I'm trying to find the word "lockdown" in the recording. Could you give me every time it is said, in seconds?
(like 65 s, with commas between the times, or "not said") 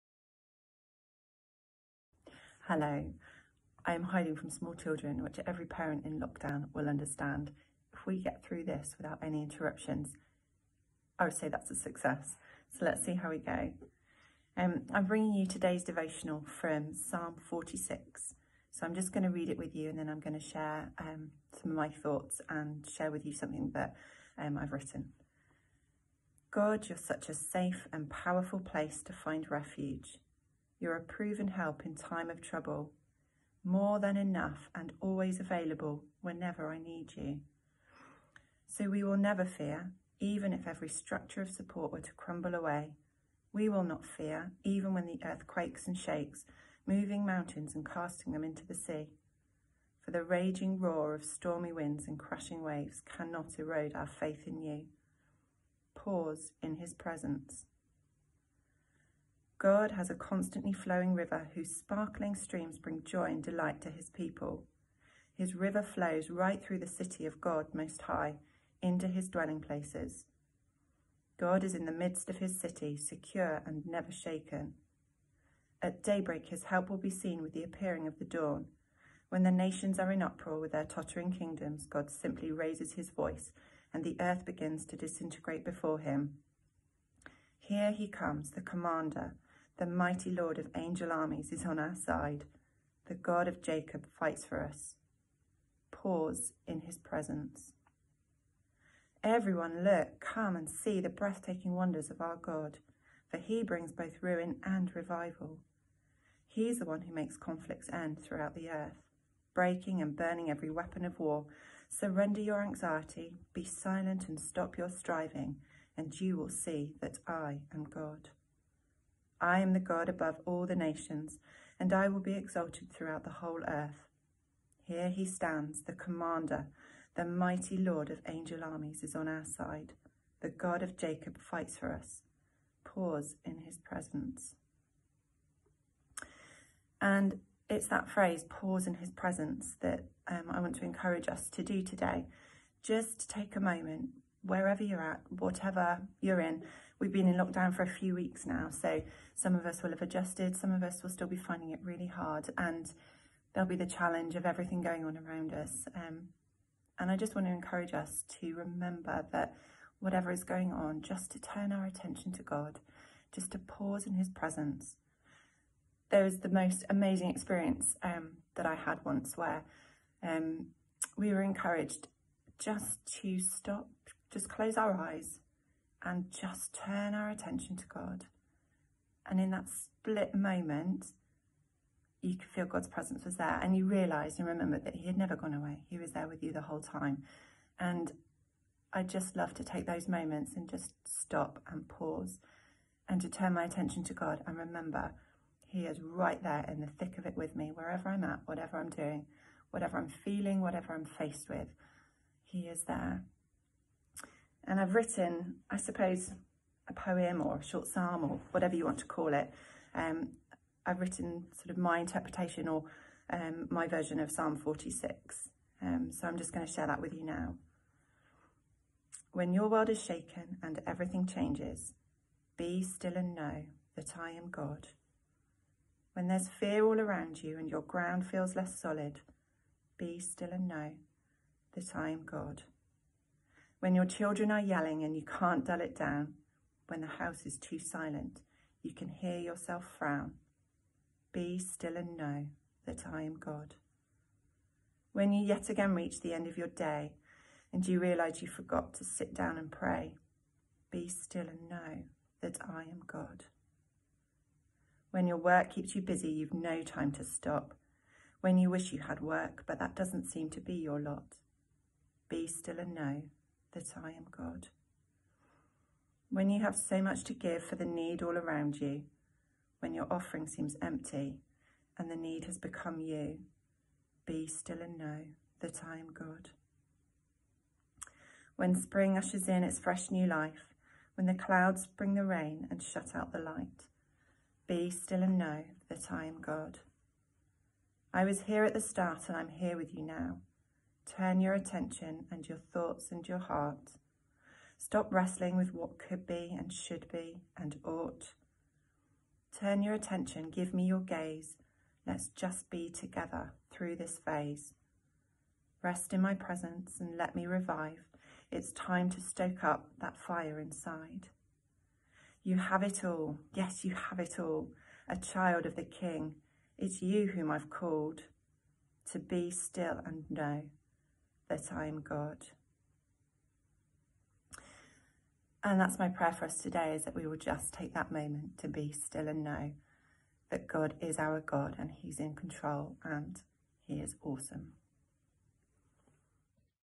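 6 s, 147 s.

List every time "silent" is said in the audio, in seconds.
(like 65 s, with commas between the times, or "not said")
113 s, 237 s.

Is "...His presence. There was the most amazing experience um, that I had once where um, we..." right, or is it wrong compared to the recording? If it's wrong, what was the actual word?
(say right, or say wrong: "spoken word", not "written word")
right.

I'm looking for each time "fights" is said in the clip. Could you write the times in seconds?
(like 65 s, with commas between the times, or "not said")
94 s, 131 s.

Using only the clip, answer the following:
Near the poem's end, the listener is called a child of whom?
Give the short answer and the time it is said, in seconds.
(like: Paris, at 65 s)
the King, at 315 s.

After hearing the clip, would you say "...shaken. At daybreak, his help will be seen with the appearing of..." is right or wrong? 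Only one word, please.
right.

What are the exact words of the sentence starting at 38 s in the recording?
So we will never fear, even if every structure of support were to crumble away.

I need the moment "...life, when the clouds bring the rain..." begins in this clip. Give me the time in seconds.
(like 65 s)
280 s.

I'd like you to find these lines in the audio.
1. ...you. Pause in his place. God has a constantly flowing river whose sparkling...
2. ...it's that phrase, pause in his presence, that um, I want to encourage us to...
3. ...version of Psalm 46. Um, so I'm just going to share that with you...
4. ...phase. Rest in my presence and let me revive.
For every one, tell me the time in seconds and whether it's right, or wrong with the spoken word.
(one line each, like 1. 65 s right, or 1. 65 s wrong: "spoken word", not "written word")
1. 54 s wrong: "presence", not "place"
2. 137 s right
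3. 213 s right
4. 304 s right.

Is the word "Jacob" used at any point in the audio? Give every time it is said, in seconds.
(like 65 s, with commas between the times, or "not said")
93 s, 130 s.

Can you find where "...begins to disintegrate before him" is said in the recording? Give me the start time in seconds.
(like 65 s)
84 s.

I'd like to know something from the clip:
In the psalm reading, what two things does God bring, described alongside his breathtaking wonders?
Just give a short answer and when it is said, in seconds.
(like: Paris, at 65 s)
ruin and revival, at 104 s.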